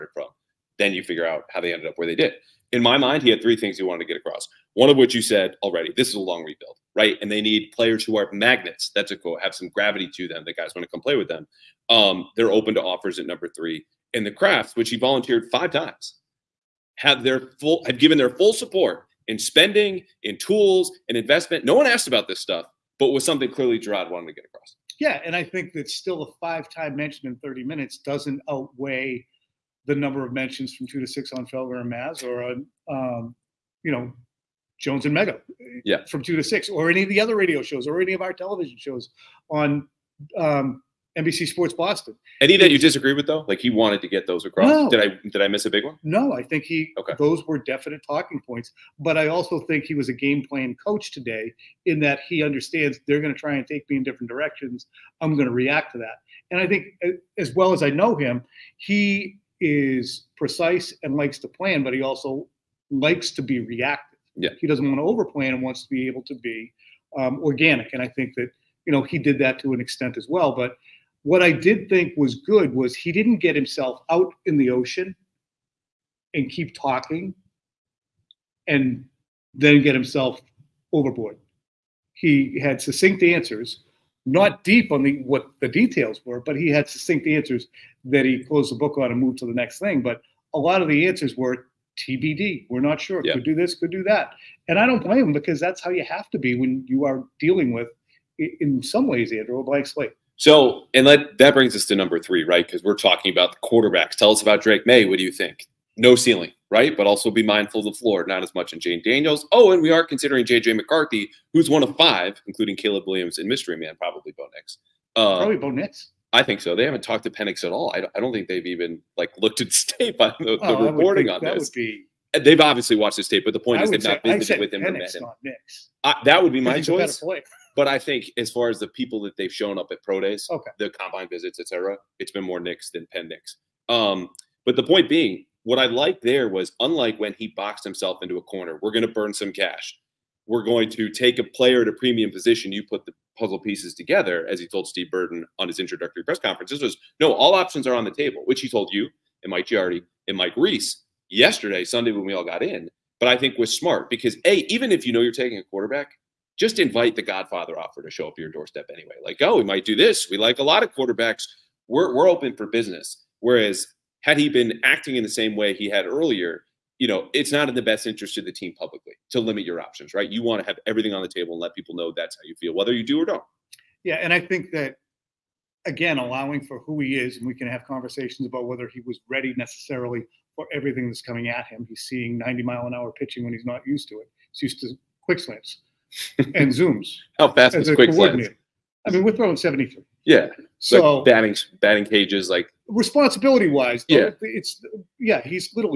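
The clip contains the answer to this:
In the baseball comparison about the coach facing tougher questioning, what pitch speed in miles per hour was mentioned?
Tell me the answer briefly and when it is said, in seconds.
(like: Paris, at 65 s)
90, at 182 s.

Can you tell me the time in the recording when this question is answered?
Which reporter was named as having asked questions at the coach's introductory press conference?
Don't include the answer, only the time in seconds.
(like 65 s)
144 s.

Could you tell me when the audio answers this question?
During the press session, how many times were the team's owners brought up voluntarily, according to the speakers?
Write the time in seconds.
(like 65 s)
15 s.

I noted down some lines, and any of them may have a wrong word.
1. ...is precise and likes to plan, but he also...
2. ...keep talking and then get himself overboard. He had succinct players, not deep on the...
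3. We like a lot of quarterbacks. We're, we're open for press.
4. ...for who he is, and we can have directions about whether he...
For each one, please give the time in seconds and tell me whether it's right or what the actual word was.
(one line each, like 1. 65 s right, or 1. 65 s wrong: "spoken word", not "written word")
1. 59 s right
2. 76 s wrong: "answers", not "players"
3. 160 s wrong: "business", not "press"
4. 176 s wrong: "conversations", not "directions".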